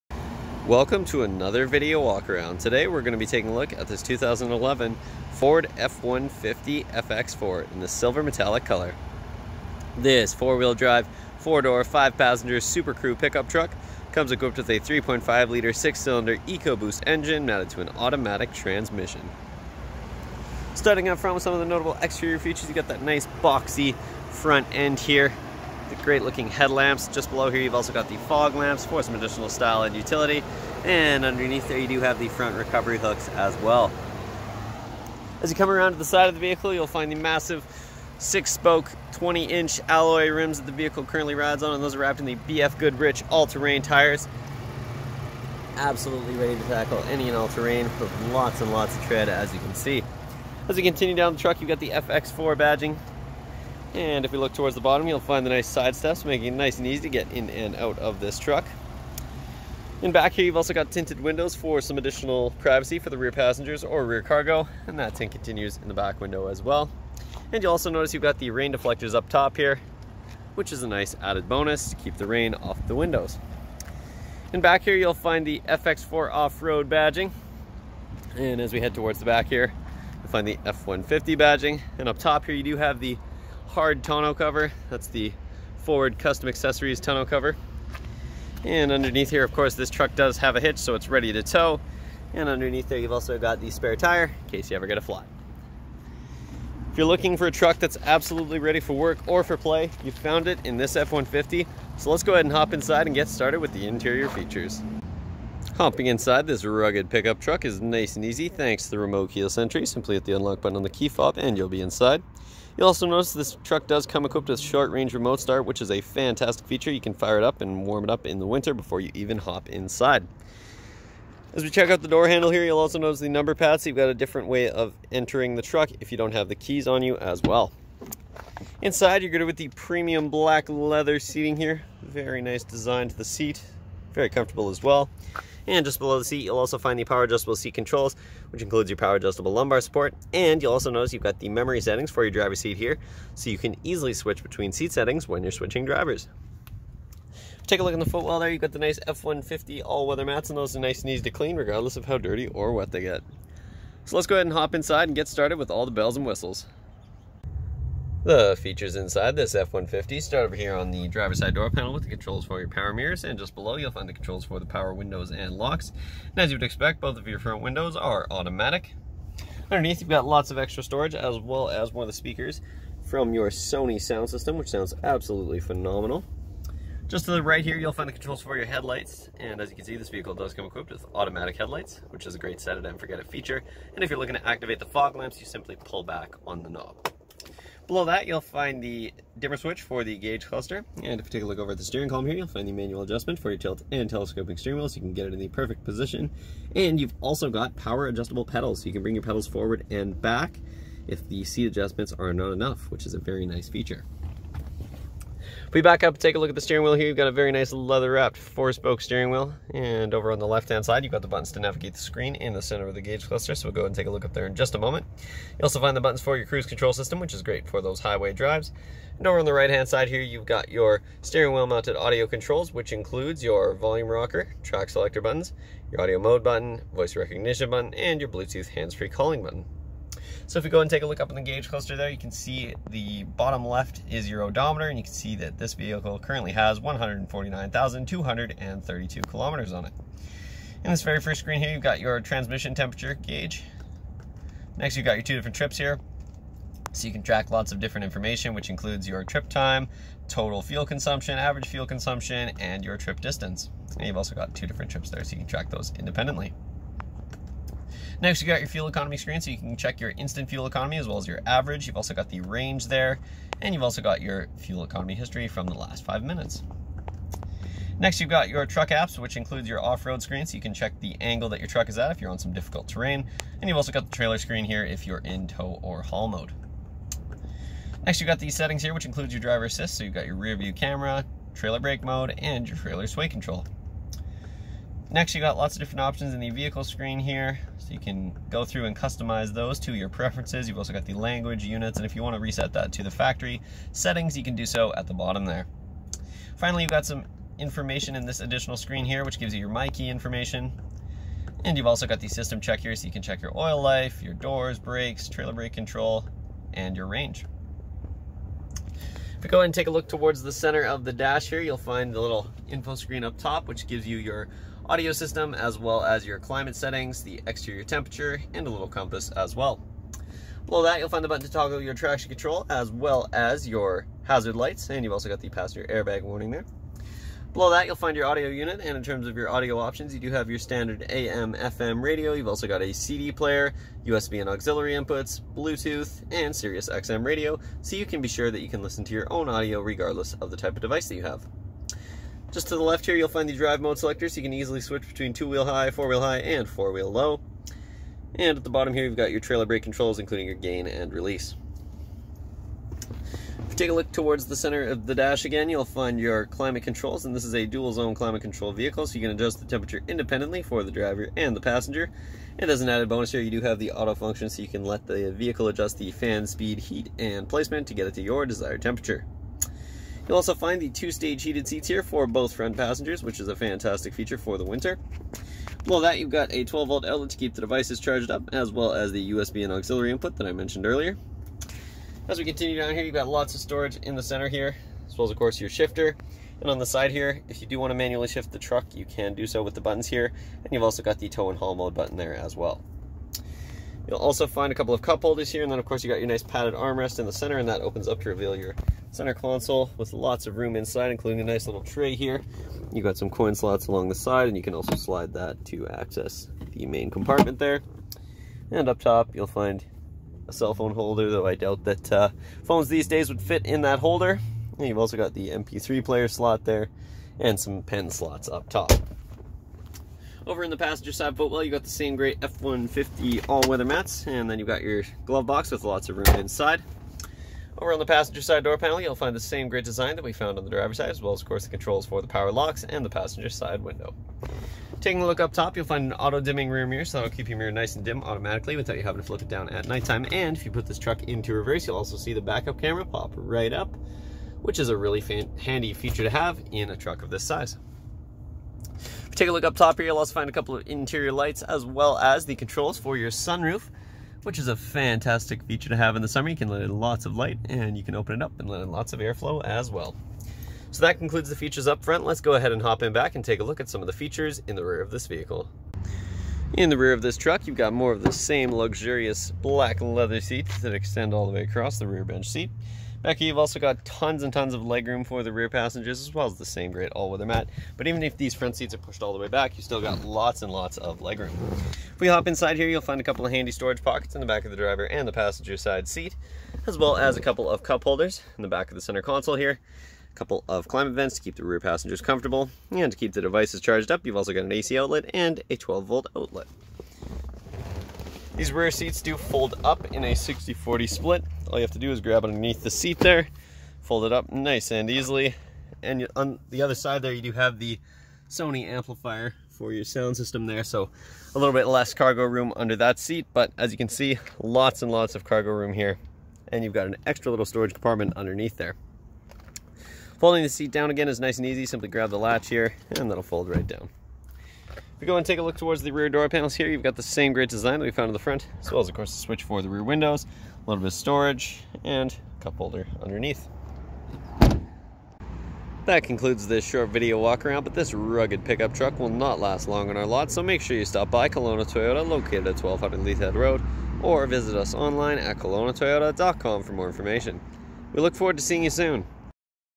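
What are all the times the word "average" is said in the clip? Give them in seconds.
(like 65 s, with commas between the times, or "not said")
251 s, 261 s.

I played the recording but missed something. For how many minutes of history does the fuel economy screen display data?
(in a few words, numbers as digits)
5.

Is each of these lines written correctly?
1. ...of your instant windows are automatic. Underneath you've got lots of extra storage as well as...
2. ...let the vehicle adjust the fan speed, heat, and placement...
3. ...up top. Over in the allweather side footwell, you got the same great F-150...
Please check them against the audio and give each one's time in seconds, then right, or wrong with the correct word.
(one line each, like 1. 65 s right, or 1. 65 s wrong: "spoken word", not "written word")
1. 167 s wrong: "front", not "instant"
2. 364 s right
3. 418 s wrong: "passenger", not "allweather".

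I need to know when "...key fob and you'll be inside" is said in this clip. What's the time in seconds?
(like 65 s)
110 s.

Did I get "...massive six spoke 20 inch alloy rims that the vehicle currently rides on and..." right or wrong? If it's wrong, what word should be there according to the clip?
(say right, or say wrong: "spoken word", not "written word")
right.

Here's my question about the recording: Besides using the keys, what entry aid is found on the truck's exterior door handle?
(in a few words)
number pads.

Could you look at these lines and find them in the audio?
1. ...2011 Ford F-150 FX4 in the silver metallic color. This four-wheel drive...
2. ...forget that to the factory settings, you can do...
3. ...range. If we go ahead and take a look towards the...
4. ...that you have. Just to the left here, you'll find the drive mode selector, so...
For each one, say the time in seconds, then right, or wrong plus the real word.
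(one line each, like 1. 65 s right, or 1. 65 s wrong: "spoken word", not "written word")
1. 4 s right
2. 292 s wrong: "reset", not "forget"
3. 307 s right
4. 341 s right.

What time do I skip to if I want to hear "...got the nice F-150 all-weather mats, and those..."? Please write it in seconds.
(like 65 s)
148 s.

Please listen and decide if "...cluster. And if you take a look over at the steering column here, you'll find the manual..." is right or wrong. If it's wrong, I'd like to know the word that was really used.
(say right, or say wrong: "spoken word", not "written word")
right.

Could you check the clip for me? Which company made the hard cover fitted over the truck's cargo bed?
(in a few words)
Forward Custom Accessories.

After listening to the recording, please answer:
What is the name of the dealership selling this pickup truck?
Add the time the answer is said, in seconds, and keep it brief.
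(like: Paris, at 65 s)
Kelowna Toyota, at 541 s.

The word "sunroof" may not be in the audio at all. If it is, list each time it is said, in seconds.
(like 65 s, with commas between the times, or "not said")
453 s.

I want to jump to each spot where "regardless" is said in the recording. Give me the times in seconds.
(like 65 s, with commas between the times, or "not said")
151 s, 339 s.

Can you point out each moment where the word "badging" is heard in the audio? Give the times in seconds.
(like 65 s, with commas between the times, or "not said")
52 s, 76 s, 81 s.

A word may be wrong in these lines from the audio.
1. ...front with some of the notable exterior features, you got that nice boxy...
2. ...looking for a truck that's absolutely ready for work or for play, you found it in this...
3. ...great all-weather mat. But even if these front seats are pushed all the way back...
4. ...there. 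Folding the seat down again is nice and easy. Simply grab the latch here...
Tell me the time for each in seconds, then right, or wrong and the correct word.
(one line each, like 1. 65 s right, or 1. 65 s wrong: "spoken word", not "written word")
1. 21 s right
2. 97 s right
3. 476 s right
4. 518 s right.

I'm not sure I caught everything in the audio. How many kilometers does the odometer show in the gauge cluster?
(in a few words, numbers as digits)
149,232.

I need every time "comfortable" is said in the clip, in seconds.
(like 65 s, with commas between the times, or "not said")
134 s, 492 s.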